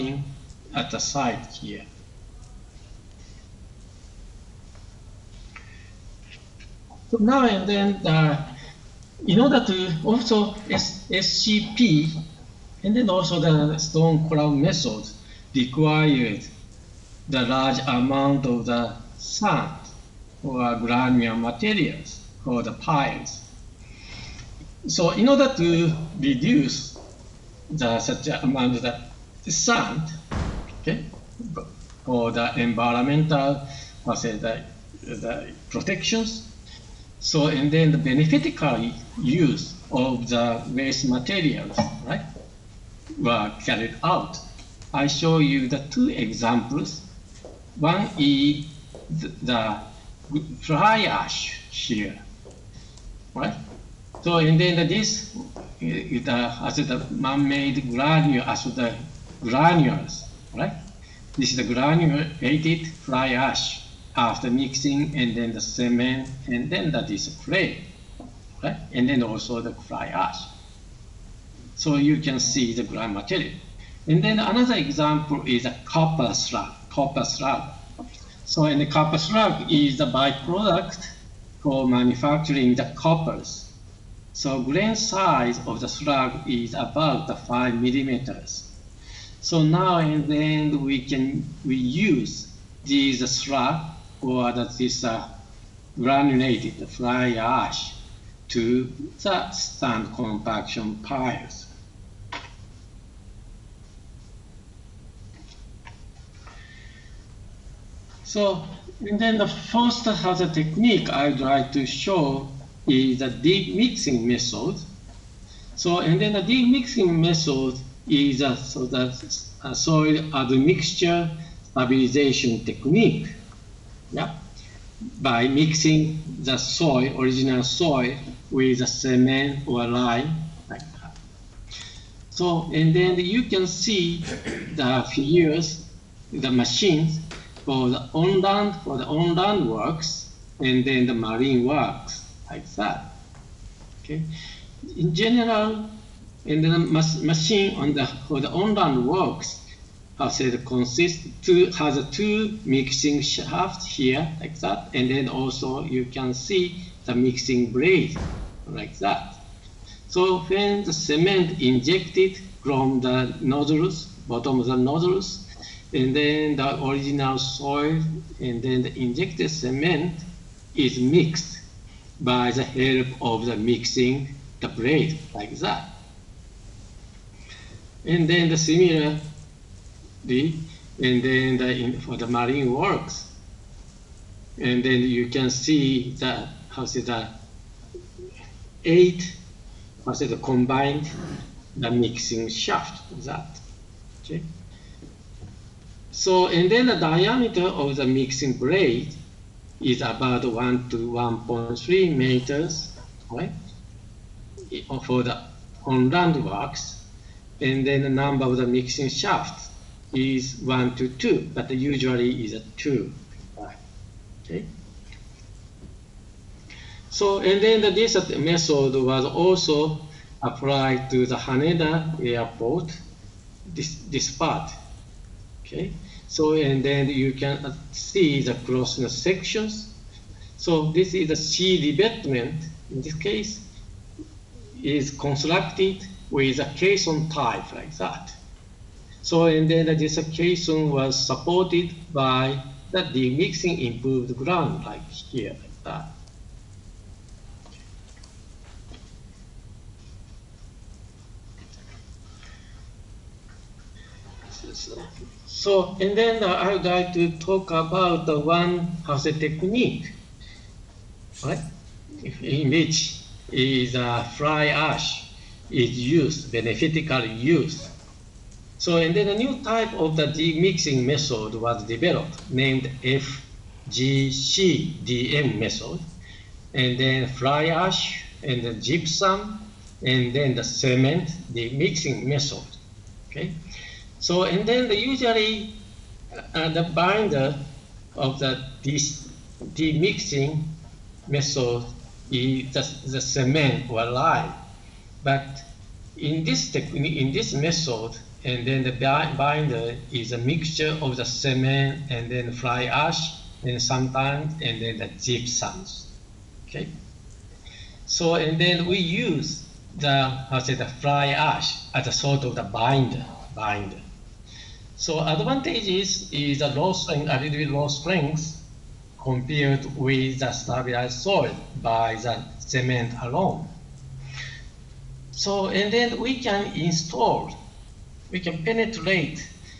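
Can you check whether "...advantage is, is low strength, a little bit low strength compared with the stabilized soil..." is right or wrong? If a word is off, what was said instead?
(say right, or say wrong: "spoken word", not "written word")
right.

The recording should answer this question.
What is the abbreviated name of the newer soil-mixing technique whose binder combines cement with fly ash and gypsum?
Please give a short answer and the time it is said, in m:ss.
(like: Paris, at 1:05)
FGCDM method, at 4:33.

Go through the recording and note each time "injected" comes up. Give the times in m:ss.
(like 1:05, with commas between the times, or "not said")
2:41, 2:49.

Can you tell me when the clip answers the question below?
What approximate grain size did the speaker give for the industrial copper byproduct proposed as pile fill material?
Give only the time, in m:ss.
1:27.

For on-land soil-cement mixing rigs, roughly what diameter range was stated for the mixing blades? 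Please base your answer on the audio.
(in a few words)
1 to 1.3 meters.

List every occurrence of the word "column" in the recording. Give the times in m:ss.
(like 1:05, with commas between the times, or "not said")
0:14.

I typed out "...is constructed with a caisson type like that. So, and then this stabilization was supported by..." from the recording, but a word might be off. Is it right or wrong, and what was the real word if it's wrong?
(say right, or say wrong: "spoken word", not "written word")
wrong: "caisson", not "stabilization".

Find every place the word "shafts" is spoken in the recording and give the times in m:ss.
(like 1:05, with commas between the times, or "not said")
2:33, 3:12, 3:29.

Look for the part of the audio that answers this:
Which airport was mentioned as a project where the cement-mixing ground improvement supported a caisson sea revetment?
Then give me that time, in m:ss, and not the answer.
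3:41.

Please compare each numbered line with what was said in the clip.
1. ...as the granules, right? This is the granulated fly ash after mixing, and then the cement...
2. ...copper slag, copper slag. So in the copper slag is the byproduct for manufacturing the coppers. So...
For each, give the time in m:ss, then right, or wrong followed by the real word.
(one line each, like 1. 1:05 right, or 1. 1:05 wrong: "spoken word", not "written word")
1. 0:58 right
2. 1:15 right.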